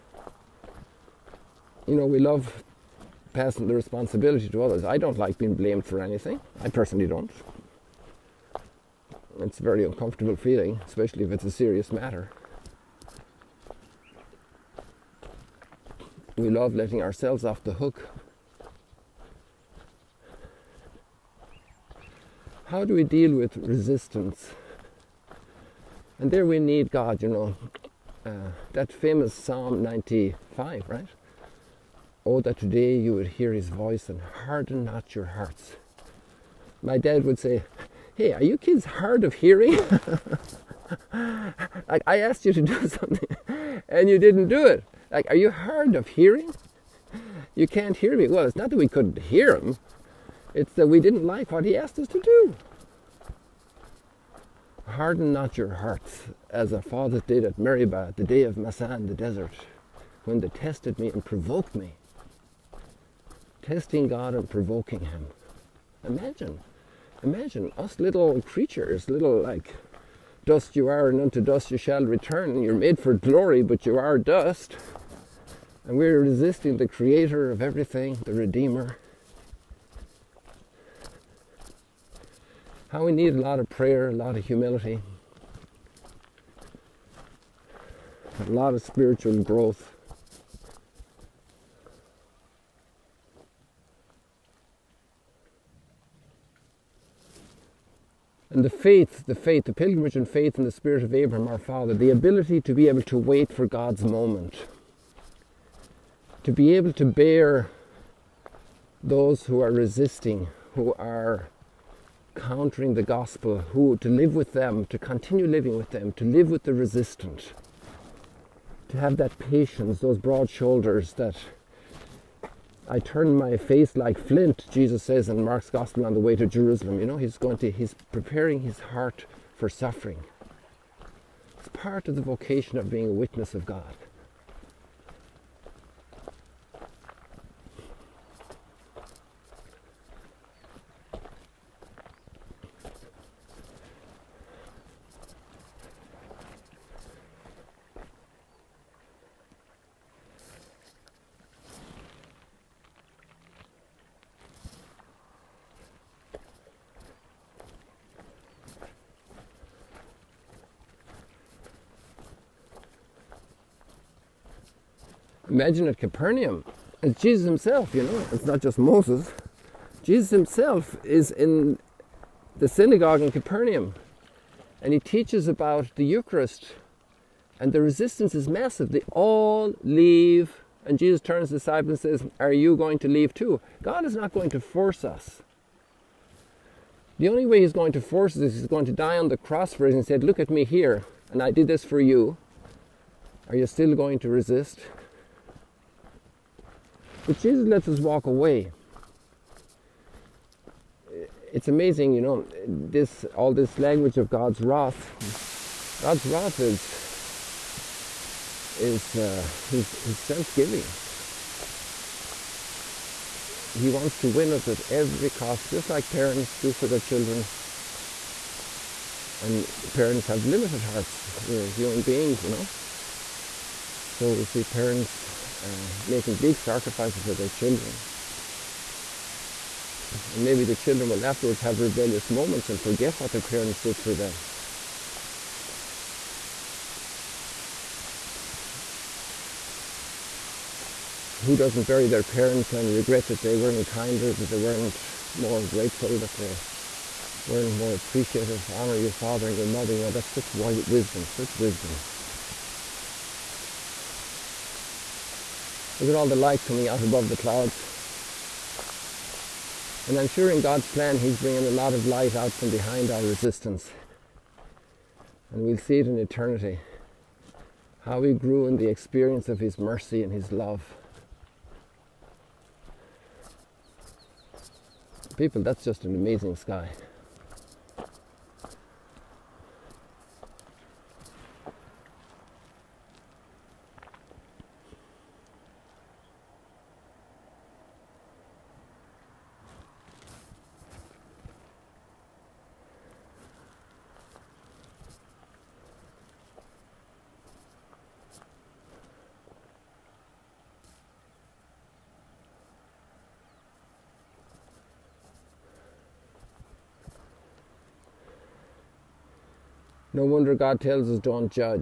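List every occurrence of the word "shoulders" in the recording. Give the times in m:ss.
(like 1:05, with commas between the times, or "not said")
2:00.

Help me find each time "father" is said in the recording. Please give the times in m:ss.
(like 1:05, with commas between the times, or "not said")
0:56, 1:41, 4:09.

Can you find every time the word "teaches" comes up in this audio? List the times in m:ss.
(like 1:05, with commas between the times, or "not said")
2:54.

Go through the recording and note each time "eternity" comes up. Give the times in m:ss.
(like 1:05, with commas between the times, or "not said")
4:26.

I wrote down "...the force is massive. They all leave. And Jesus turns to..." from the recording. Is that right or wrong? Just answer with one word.
wrong.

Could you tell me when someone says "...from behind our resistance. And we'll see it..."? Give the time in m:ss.
4:22.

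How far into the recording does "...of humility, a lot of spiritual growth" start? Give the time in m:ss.
1:24.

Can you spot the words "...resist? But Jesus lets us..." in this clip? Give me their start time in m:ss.
3:14.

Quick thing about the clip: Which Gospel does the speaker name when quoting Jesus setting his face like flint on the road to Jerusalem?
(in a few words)
Mark's Gospel.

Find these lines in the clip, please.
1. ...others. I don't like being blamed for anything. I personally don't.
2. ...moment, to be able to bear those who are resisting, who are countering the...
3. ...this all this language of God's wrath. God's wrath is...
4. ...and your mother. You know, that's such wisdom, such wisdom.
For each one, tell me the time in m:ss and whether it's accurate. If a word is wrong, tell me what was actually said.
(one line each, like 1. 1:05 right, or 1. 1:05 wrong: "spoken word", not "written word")
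1. 0:04 right
2. 1:44 right
3. 3:22 right
4. 4:09 right.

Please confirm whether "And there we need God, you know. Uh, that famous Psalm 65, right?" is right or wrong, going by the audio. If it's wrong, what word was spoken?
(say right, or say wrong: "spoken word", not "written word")
wrong: "95", not "65".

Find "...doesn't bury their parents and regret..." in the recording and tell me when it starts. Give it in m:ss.
4:01.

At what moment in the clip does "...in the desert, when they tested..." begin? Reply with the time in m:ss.
0:58.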